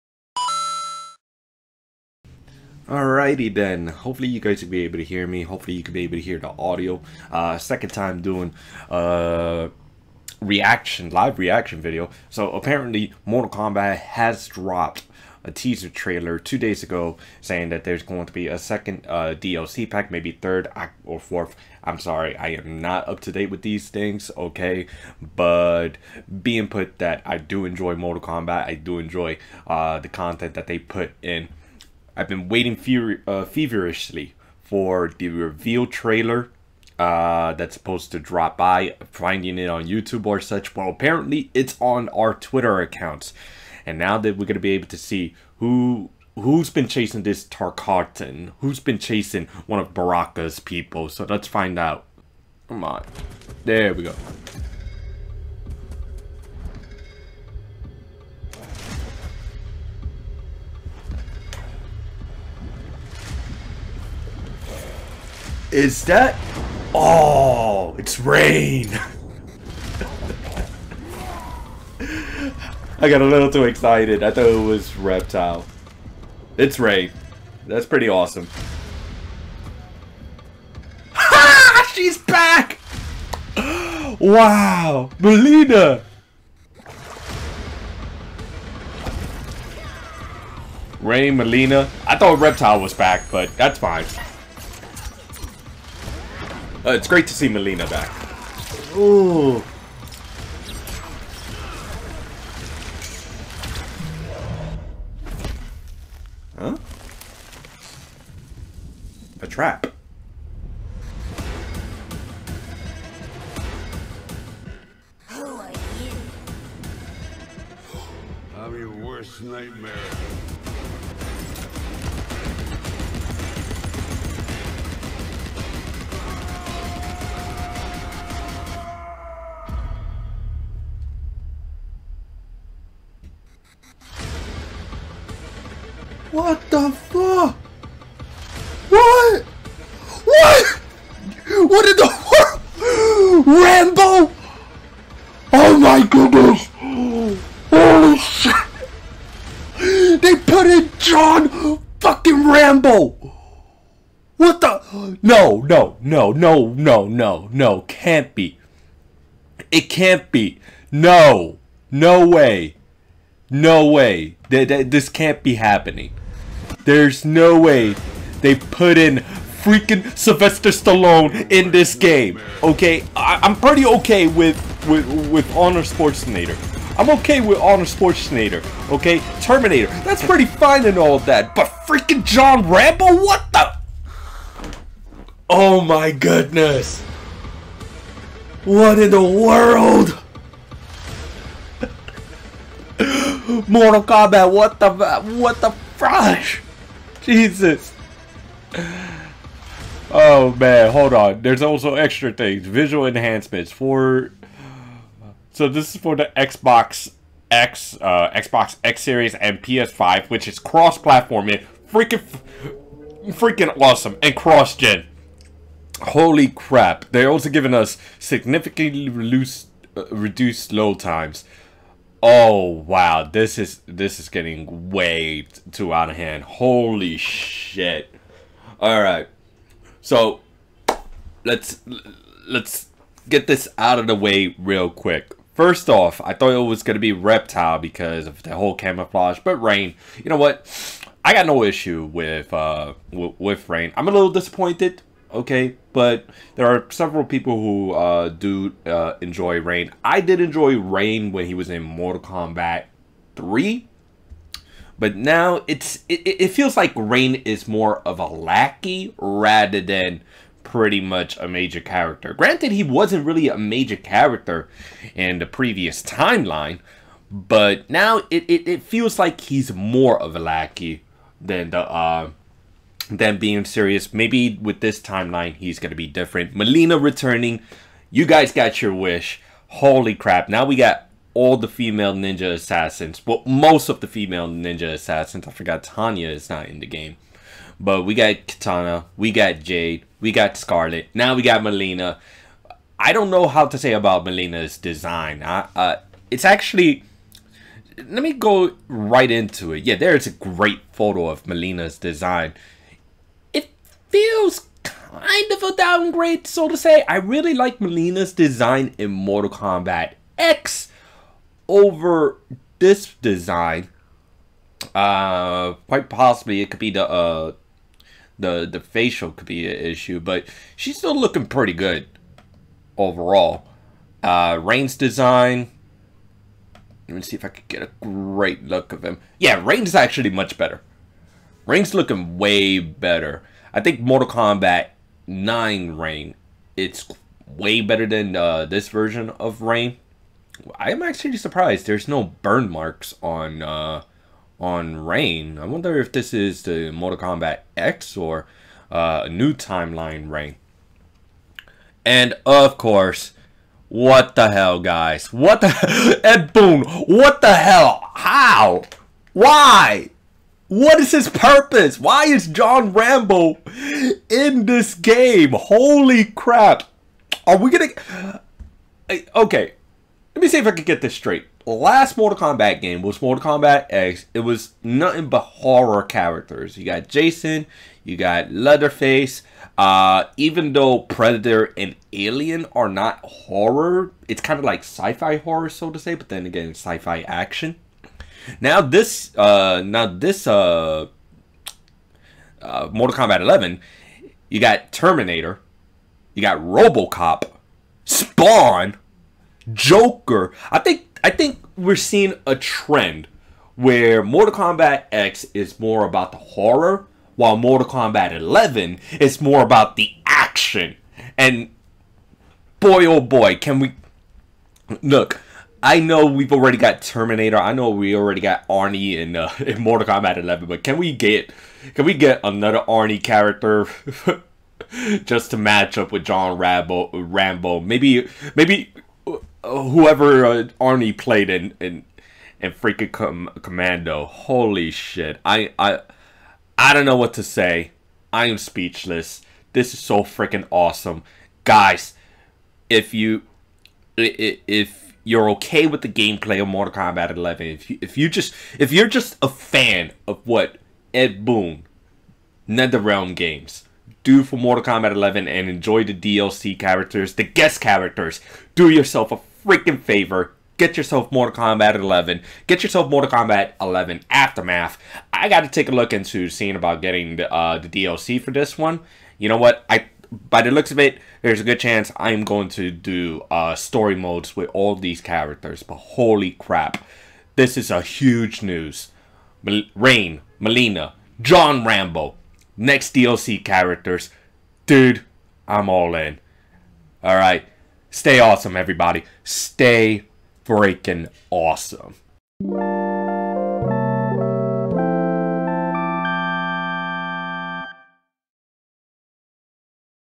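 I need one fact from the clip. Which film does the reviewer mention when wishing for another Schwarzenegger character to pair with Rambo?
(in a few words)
Commando.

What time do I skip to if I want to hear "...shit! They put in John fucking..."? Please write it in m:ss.
2:28.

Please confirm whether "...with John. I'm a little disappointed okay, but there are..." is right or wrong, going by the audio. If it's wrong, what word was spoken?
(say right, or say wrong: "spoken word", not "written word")
wrong: "Rain", not "John".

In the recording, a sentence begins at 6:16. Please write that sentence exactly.
You got Jason, you got Leatherface.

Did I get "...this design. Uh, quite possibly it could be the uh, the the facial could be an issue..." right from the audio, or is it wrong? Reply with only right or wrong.
right.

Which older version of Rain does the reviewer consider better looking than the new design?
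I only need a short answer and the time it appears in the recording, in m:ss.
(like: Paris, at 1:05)
Mortal Kombat 9, at 5:34.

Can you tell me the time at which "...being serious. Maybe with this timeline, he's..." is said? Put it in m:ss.
4:33.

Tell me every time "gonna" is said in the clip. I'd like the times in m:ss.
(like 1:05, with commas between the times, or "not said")
0:44, 6:07.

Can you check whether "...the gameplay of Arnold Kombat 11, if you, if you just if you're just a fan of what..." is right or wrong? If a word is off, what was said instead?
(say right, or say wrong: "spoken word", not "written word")
wrong: "Mortal", not "Arnold".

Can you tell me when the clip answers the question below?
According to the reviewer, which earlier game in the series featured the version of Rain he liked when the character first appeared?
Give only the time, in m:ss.
4:11.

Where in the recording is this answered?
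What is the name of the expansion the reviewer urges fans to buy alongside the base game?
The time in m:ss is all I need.
7:44.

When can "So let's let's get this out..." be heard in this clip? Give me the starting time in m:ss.
3:50.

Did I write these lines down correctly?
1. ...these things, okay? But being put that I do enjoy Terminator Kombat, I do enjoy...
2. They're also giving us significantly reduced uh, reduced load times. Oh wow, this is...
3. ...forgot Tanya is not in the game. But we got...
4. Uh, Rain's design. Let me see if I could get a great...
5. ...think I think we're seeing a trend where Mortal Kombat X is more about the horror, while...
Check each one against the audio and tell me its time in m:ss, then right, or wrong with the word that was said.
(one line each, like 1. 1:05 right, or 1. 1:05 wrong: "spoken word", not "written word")
1. 0:23 wrong: "Mortal", not "Terminator"
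2. 3:37 right
3. 4:45 right
4. 5:24 right
5. 6:40 right.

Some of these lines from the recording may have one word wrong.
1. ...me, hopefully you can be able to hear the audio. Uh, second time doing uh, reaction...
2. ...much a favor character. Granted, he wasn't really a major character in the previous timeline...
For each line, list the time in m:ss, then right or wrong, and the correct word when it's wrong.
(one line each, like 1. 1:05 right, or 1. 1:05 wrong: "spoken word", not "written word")
1. 0:05 right
2. 4:21 wrong: "major", not "favor".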